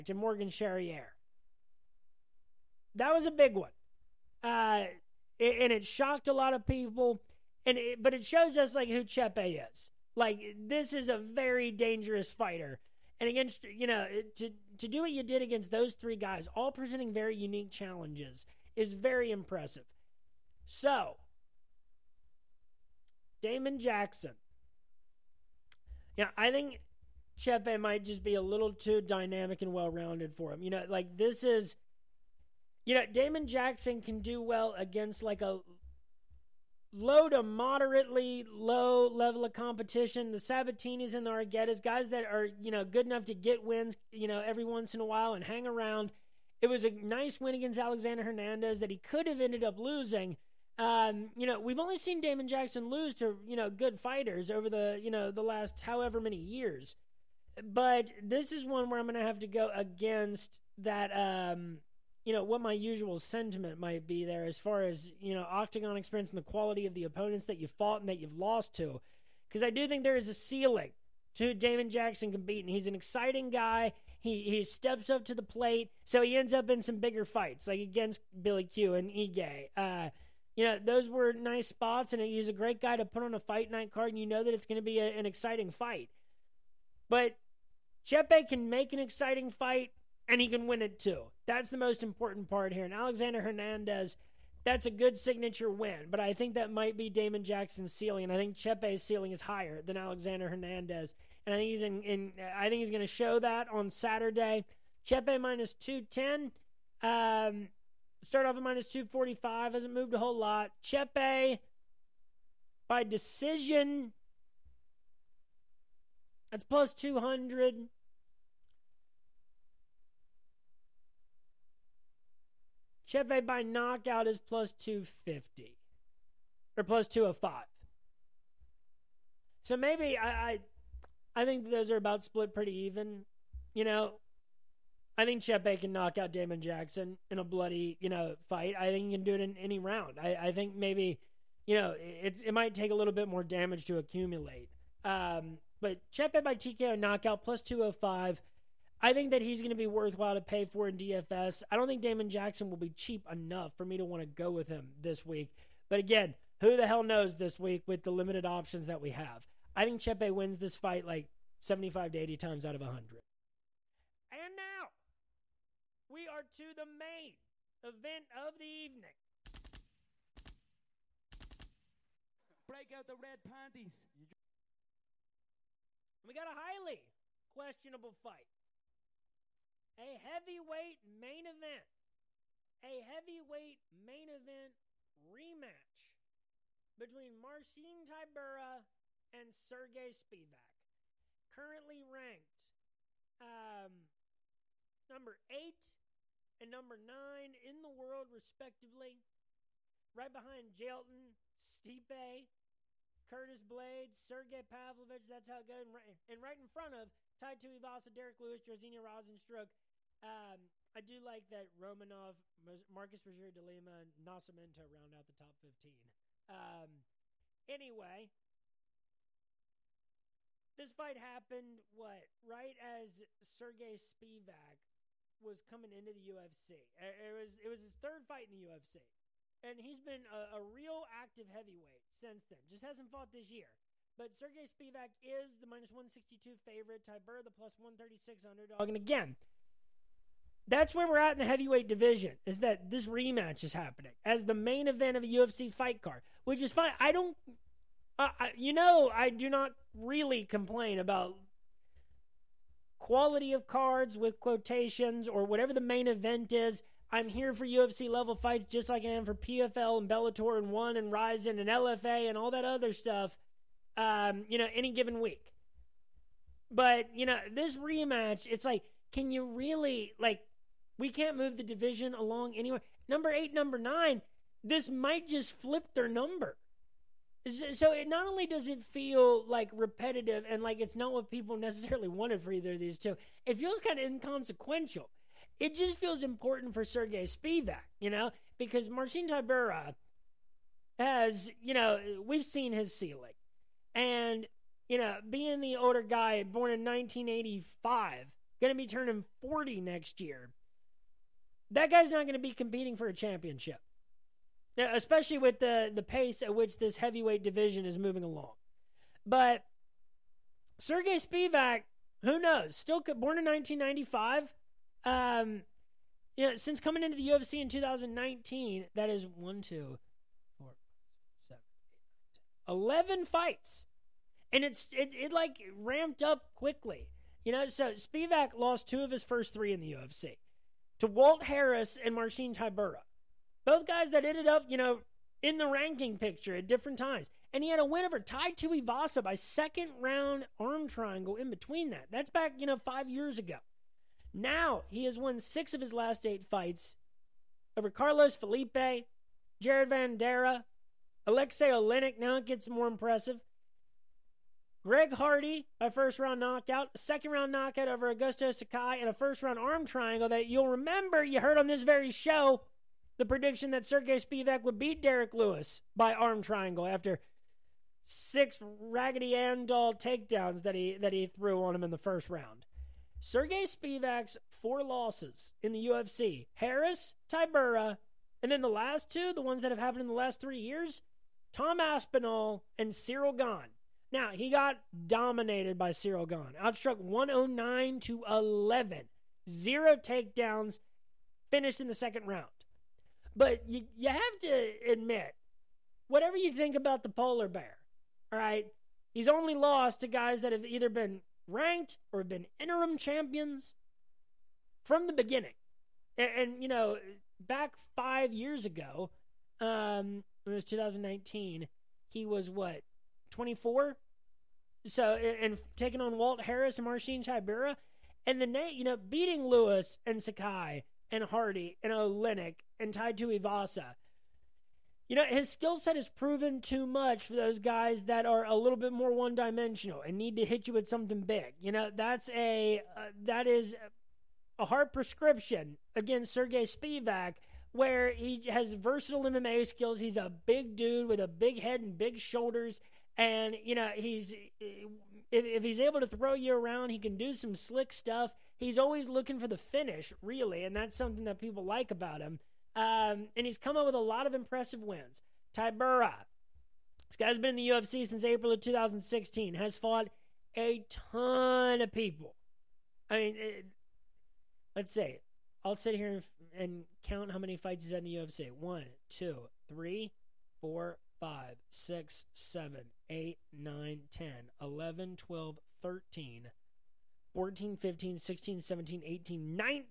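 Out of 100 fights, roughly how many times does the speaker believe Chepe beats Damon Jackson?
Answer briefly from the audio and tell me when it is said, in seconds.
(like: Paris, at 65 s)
75 to 80, at 161 s.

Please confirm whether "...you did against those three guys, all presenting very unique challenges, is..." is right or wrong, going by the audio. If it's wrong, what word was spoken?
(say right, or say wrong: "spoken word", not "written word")
right.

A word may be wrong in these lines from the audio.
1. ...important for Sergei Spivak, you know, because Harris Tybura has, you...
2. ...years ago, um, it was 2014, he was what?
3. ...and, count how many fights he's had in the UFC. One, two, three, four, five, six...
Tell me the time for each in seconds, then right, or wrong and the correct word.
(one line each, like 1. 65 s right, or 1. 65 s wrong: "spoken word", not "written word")
1. 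286 s wrong: "Marcin", not "Harris"
2. 408 s wrong: "2019", not "2014"
3. 466 s right.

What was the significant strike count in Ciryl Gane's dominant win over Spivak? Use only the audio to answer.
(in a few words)
109 to 11.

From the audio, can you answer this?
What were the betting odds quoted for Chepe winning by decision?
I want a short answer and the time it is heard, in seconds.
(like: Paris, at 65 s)
+200, at 116 s.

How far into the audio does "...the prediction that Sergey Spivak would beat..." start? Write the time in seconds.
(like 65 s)
363 s.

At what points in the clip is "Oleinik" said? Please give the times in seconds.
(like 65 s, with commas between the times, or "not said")
351 s, 421 s.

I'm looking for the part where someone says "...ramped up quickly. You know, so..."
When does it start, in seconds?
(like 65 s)
325 s.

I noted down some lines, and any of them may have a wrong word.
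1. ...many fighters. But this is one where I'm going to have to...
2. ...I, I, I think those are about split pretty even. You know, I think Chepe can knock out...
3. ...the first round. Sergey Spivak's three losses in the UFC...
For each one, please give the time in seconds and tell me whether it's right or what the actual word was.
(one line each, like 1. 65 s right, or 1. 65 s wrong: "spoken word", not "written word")
1. 56 s wrong: "years", not "fighters"
2. 130 s right
3. 371 s wrong: "four", not "three".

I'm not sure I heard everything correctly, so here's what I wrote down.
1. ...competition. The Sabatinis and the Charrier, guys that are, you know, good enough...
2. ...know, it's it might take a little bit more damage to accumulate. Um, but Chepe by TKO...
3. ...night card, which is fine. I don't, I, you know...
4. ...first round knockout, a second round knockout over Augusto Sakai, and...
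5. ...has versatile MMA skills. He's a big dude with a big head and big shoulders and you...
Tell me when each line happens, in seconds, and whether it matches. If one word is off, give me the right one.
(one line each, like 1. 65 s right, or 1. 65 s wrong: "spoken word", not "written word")
1. 39 s wrong: "Arguetas", not "Charrier"
2. 141 s right
3. 245 s wrong: "fight", not "night"
4. 355 s right
5. 438 s right.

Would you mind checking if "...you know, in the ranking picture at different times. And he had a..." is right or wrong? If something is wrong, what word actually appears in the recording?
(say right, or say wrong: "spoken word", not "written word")
right.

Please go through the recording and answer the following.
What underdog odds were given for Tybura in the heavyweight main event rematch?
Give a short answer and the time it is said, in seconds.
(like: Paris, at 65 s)
+136, at 237 s.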